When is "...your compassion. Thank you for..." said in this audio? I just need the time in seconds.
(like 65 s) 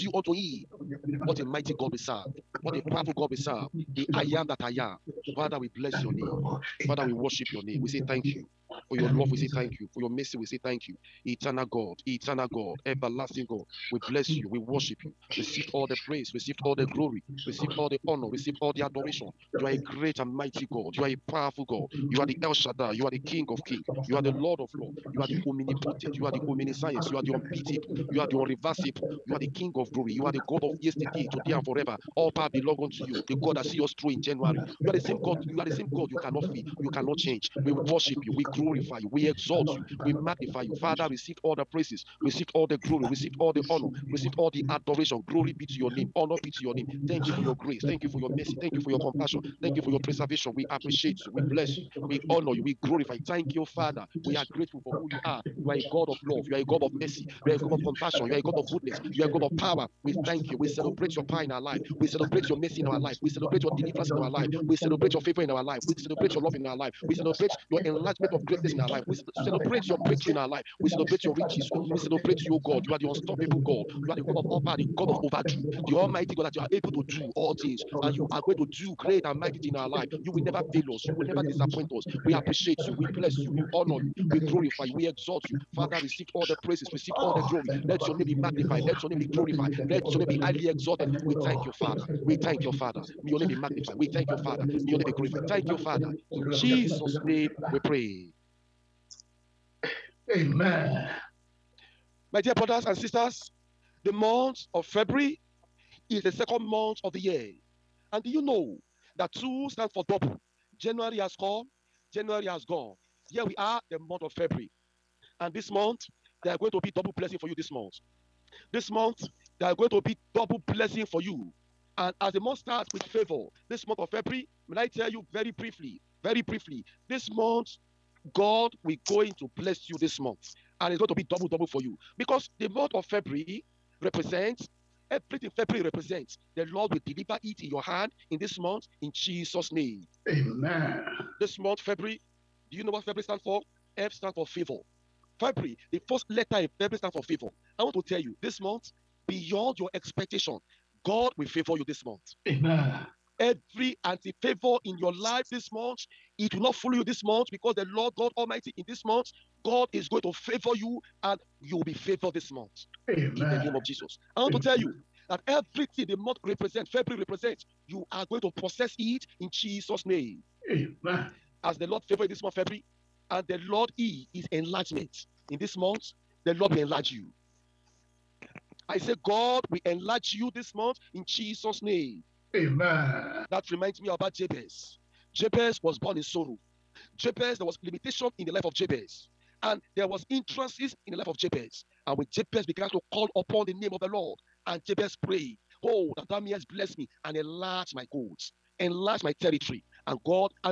48 s.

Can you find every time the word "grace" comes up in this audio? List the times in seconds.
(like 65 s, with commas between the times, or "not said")
47 s.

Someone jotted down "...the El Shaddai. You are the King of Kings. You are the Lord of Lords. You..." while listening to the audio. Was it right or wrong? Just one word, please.
right.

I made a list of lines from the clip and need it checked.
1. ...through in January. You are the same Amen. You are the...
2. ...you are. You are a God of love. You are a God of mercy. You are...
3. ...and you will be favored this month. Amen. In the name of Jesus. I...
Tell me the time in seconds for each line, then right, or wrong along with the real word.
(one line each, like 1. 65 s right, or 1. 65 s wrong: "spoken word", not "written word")
1. 33 s wrong: "God", not "Amen"
2. 55 s right
3. 161 s right.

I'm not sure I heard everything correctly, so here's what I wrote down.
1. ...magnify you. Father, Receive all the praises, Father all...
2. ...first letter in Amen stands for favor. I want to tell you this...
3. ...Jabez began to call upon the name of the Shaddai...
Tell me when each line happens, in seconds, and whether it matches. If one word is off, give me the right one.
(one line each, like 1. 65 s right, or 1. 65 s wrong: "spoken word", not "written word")
1. 40 s wrong: "Receive", not "Father"
2. 146 s wrong: "February", not "Amen"
3. 192 s wrong: "Lord", not "Shaddai".